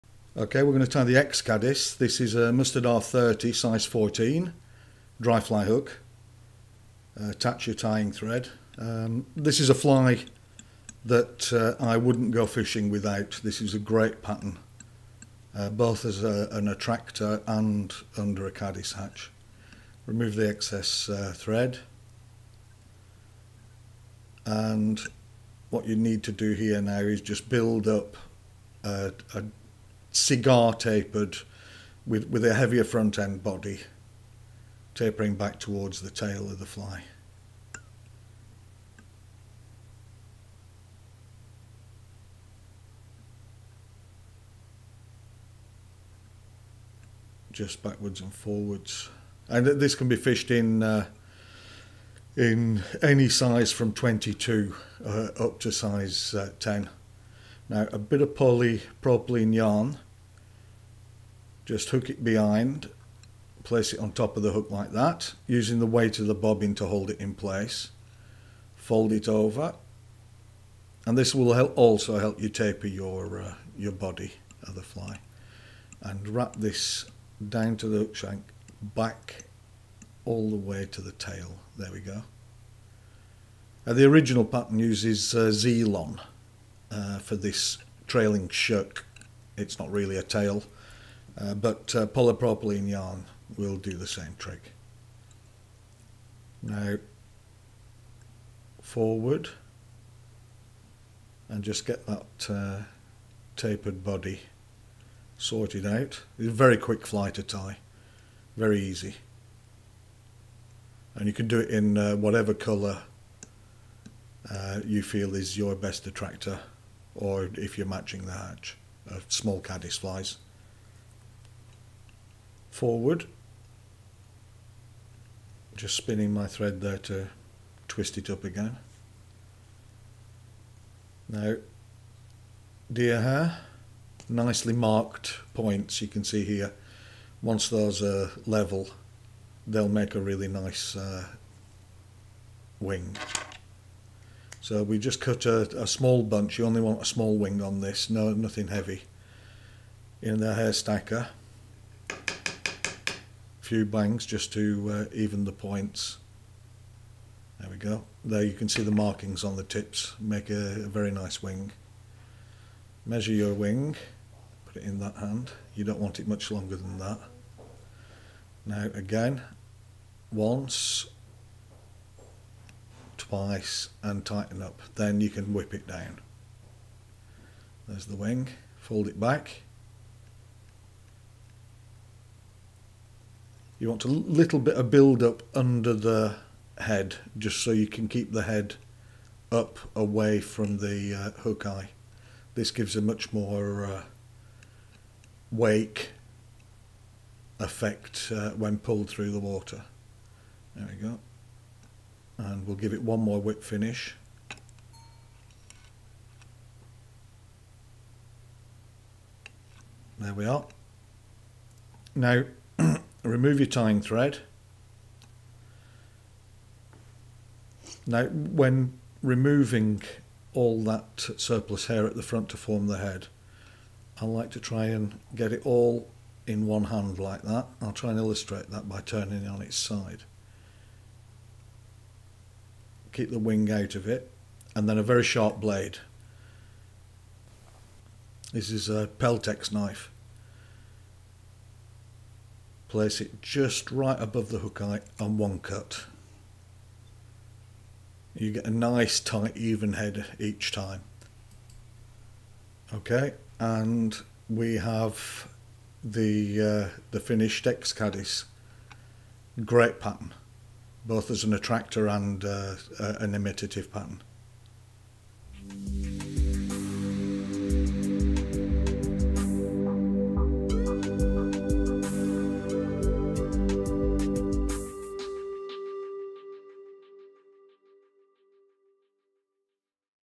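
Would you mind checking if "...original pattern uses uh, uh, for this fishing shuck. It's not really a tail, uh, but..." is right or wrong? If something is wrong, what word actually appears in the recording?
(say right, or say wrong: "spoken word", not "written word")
wrong: "trailing", not "fishing".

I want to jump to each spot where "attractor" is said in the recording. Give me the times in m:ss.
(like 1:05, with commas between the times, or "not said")
0:16, 1:56, 4:21.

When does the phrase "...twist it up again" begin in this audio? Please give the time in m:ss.
2:07.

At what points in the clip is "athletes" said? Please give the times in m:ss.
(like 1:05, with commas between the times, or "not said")
not said.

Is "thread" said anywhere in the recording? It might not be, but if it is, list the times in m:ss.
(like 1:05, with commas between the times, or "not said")
0:08, 0:21, 2:06, 3:33.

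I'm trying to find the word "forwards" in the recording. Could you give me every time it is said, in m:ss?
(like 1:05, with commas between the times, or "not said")
0:48, 1:38, 2:02.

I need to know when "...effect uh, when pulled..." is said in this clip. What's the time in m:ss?
3:17.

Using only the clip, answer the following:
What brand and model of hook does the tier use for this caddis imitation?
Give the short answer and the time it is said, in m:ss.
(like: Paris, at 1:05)
Mustad R30, at 0:02.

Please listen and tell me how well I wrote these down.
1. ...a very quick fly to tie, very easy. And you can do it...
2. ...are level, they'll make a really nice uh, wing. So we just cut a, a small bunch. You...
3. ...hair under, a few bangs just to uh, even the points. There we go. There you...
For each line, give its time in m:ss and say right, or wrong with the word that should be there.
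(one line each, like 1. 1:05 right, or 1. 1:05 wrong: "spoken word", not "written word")
1. 1:46 right
2. 2:18 right
3. 2:30 wrong: "stacker", not "under".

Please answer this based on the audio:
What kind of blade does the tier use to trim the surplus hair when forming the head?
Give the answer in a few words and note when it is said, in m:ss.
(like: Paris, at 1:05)
Peltex knife, at 3:59.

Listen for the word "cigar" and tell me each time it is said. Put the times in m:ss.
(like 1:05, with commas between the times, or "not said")
0:30.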